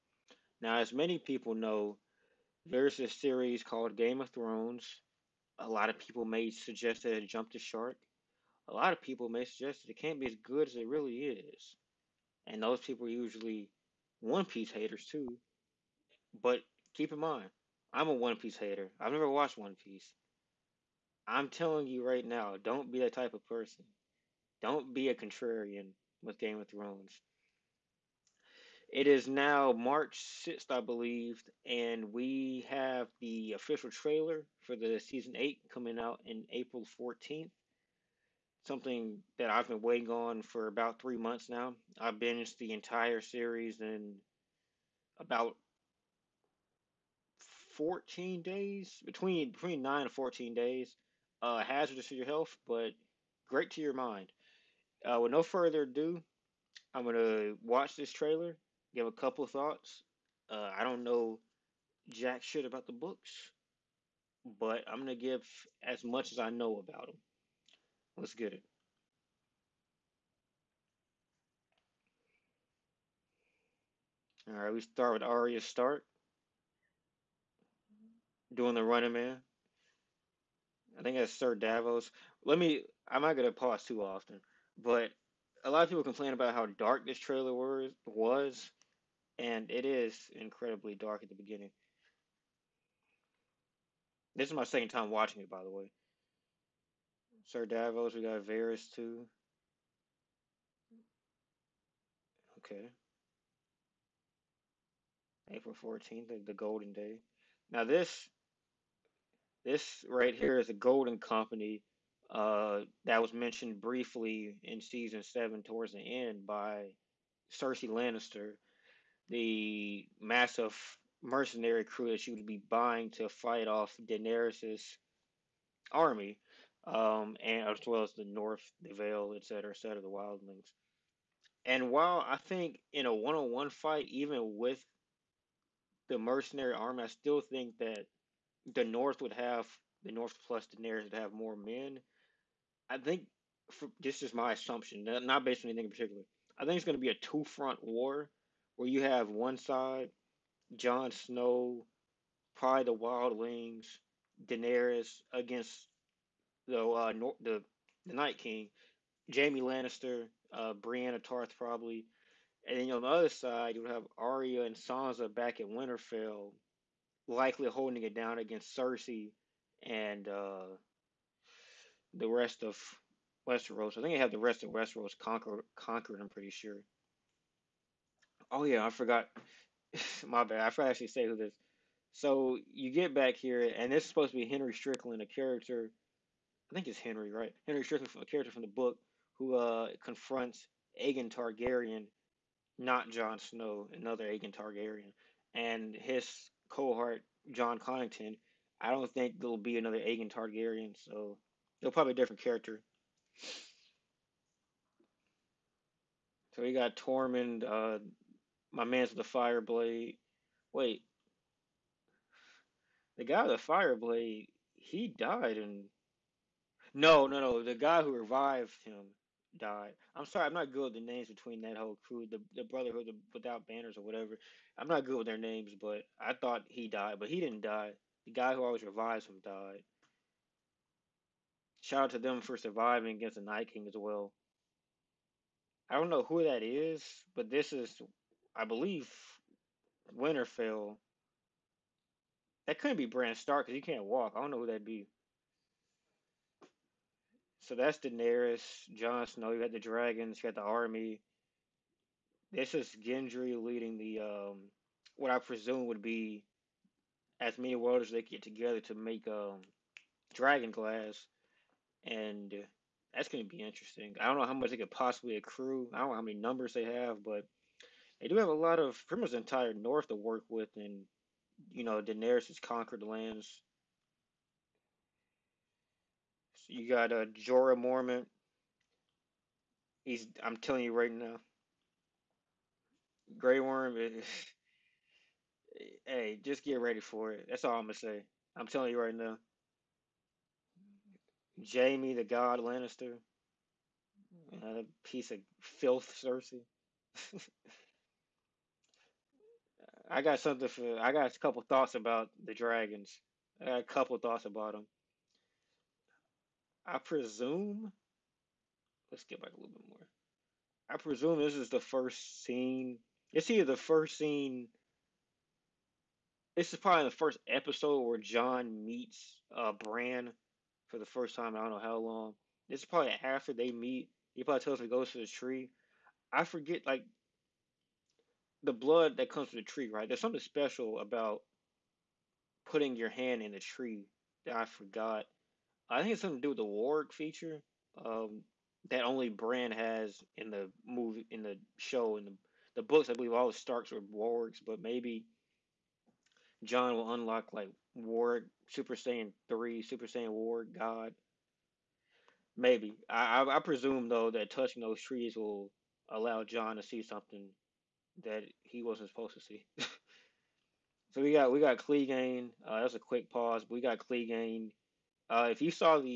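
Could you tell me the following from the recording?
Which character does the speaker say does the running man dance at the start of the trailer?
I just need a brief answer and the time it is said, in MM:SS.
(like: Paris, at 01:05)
Arya Stark, at 01:15.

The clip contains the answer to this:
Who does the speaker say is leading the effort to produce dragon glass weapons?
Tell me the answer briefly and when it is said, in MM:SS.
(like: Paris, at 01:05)
Gendry, at 04:13.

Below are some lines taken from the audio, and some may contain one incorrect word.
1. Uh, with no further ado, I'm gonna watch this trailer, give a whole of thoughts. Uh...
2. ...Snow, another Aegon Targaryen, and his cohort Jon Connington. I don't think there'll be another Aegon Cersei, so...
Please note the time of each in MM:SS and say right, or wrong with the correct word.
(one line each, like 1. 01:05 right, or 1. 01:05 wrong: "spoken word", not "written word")
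1. 00:55 wrong: "couple", not "whole"
2. 03:13 wrong: "Targaryen", not "Cersei".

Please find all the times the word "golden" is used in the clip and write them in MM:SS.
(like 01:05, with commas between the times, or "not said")
01:46, 01:50.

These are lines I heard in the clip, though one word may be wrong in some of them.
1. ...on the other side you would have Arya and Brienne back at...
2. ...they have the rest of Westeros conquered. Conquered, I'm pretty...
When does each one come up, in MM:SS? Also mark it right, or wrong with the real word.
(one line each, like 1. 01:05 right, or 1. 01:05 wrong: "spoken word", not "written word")
1. 02:42 wrong: "Sansa", not "Brienne"
2. 02:54 right.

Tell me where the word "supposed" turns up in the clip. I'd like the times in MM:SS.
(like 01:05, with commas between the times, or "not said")
03:04, 05:59.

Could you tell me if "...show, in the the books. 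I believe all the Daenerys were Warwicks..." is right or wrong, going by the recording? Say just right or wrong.
wrong.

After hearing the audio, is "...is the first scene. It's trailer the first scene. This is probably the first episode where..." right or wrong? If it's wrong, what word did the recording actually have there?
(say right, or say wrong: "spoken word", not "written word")
wrong: "either", not "trailer".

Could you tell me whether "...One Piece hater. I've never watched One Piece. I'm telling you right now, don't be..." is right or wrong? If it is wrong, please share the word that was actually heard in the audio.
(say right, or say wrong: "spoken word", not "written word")
right.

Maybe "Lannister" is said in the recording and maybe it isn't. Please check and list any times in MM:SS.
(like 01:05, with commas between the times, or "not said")
01:57, 02:39, 04:52.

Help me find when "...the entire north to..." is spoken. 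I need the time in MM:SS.
04:29.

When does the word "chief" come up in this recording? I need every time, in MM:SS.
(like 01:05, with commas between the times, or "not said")
not said.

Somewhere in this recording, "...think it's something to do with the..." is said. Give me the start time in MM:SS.
05:36.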